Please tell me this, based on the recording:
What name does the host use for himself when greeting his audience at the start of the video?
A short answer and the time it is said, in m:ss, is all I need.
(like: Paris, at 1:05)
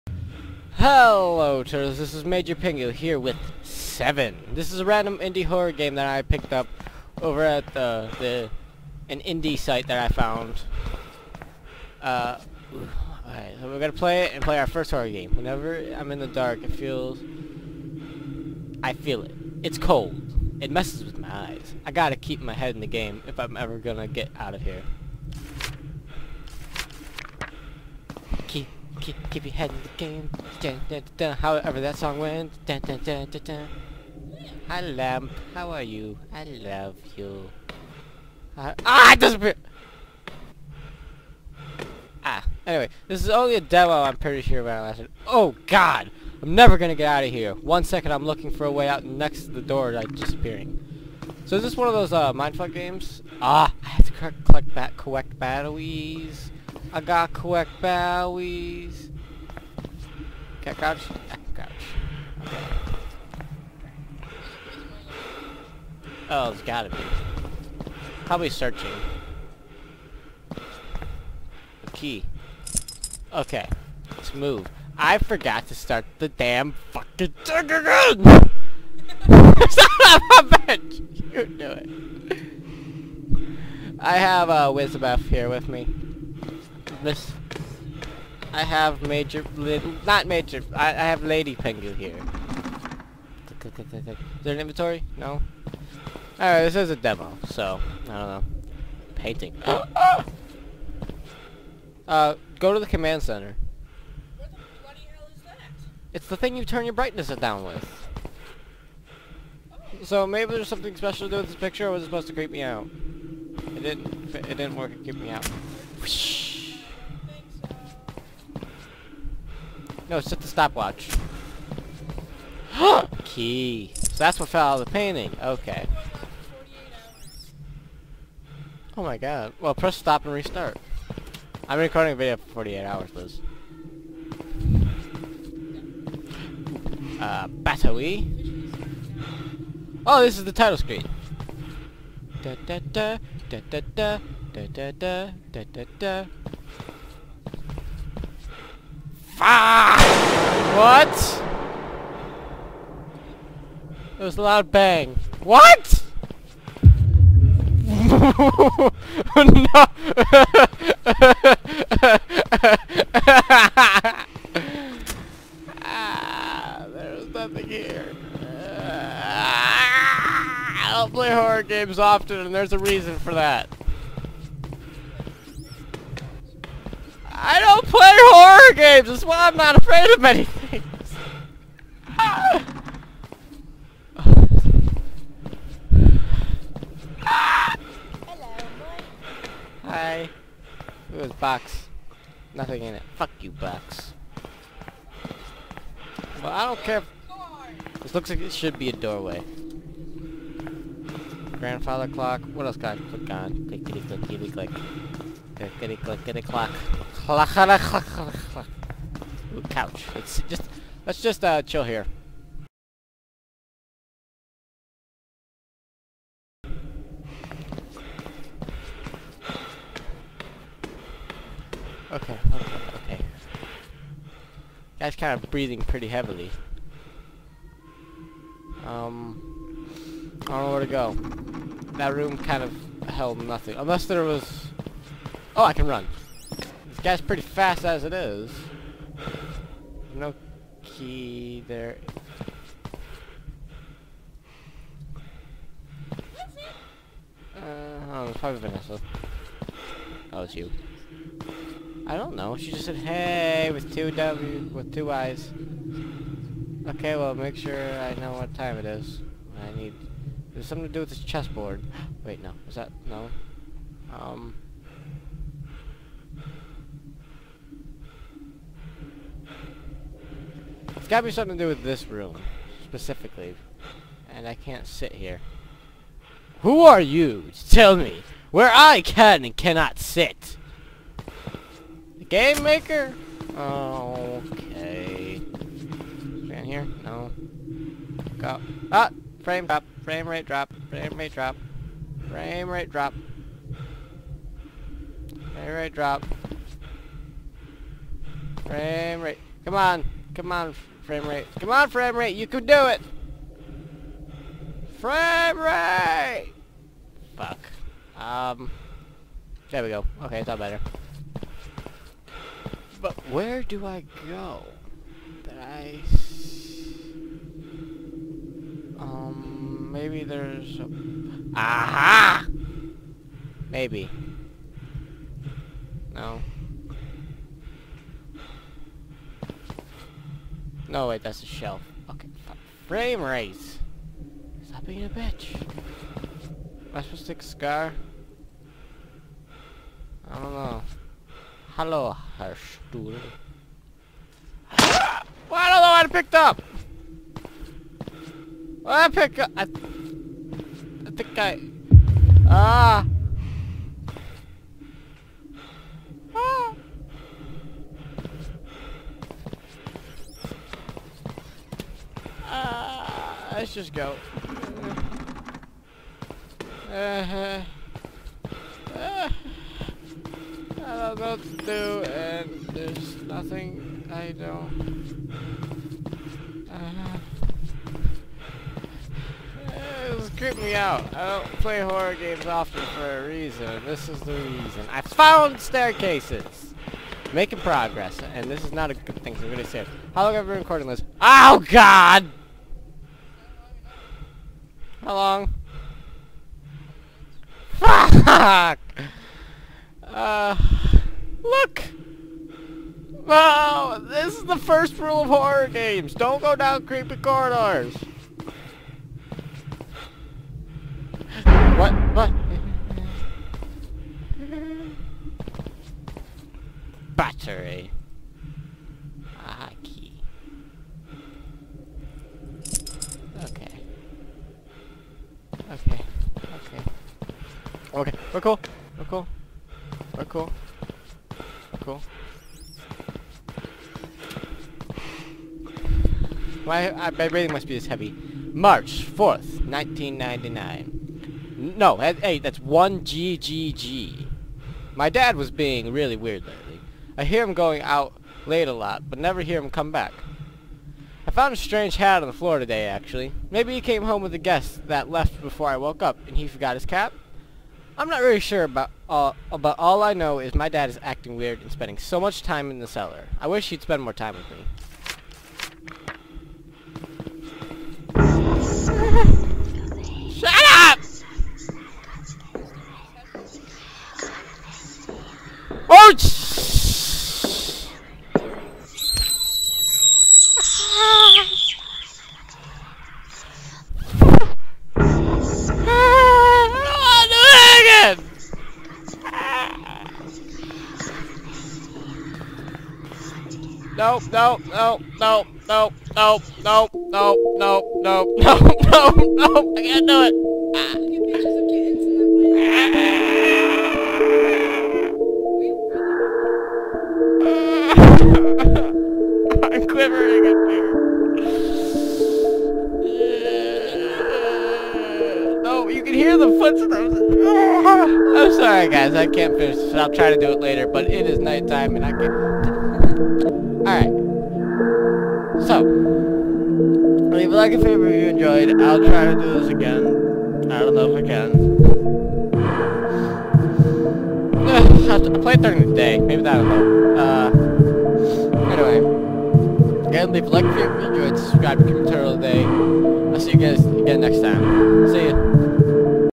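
Major Pingu, at 0:02.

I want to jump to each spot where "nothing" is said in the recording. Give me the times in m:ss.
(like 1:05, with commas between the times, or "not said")
2:47, 3:12, 3:53, 6:13.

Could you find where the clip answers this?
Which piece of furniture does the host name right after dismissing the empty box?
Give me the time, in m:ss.
3:21.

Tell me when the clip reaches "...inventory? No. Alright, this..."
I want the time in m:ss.
1:34.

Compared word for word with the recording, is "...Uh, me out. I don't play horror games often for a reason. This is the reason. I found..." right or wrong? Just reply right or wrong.
right.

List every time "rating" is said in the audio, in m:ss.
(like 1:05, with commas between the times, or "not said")
7:17.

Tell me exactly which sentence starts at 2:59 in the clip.
That's why I'm not afraid of many things.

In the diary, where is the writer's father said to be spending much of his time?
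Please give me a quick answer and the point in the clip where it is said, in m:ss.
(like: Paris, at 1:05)
the cellar, at 7:42.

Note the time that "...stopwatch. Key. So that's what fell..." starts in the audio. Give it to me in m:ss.
2:00.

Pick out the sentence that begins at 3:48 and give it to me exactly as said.
Um, I don't know where to go.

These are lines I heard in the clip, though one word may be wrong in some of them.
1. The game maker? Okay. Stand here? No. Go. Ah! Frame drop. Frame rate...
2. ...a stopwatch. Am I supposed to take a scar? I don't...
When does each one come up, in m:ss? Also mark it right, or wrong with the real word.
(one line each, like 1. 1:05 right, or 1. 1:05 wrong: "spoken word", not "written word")
1. 4:42 right
2. 5:35 wrong: "bitch", not "stopwatch".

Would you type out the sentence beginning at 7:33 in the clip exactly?
Maybe he came home with a guest that left before I woke up, and he forgot his cap?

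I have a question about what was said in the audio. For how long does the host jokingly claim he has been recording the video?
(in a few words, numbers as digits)
48 hours.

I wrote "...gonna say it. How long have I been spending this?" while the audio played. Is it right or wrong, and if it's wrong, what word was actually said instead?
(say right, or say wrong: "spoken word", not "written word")
wrong: "recording", not "spending".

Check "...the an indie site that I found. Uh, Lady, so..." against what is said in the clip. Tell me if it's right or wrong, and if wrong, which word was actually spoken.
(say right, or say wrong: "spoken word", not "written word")
wrong: "Alright", not "Lady".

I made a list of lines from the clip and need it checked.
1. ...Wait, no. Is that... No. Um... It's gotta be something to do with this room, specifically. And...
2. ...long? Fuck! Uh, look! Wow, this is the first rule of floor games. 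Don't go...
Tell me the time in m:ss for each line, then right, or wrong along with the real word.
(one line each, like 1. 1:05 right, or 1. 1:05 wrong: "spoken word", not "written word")
1. 4:22 right
2. 6:35 wrong: "horror", not "floor".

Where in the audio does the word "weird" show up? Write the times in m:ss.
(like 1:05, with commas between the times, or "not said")
7:26, 7:41.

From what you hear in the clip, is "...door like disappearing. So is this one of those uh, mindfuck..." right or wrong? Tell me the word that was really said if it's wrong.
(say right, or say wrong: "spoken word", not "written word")
right.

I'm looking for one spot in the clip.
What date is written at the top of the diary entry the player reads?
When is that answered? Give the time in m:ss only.
7:18.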